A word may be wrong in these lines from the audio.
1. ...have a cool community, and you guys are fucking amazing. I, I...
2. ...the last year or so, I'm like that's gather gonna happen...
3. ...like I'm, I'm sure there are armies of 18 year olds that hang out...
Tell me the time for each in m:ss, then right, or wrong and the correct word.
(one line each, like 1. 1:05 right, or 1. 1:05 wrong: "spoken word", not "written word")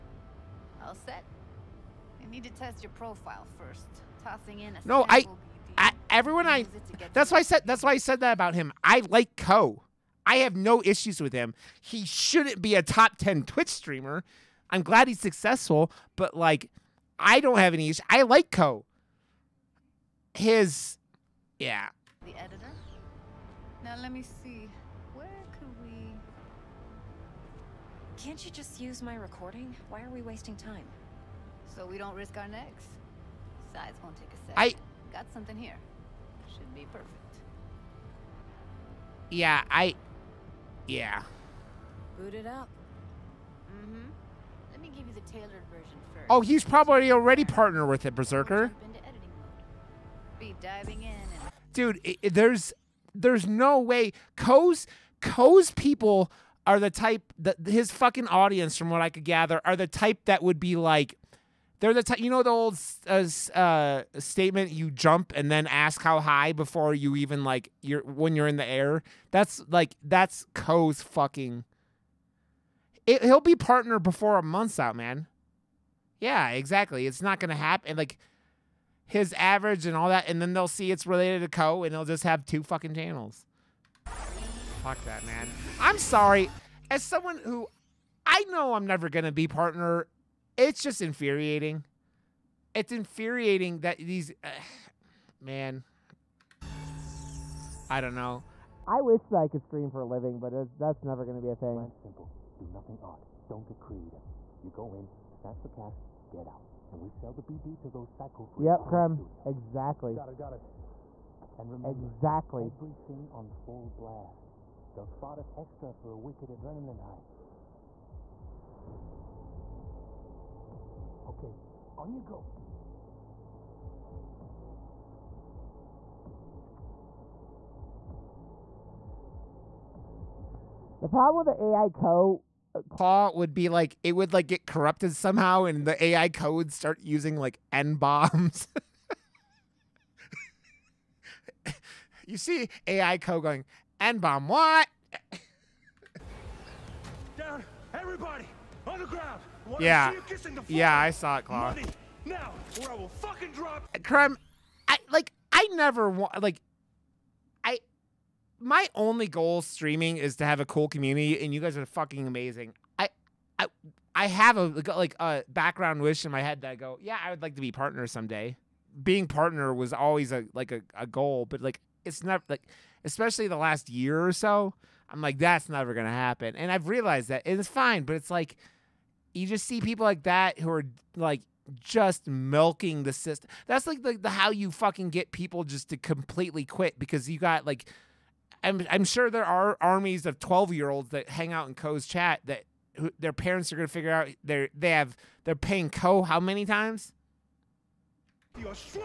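1. 2:40 right
2. 2:53 wrong: "never", not "gather"
3. 3:07 wrong: "12", not "18".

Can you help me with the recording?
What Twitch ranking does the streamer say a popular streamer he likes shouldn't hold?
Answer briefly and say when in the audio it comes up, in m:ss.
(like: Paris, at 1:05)
top ten, at 0:12.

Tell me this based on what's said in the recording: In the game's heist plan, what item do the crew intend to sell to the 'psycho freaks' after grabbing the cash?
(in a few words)
BD.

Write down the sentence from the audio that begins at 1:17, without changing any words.
Like his average and all that, and then they'll see it's related to Co, and they'll just have two fucking channels.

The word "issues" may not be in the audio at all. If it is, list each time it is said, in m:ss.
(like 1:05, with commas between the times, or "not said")
0:10, 0:17.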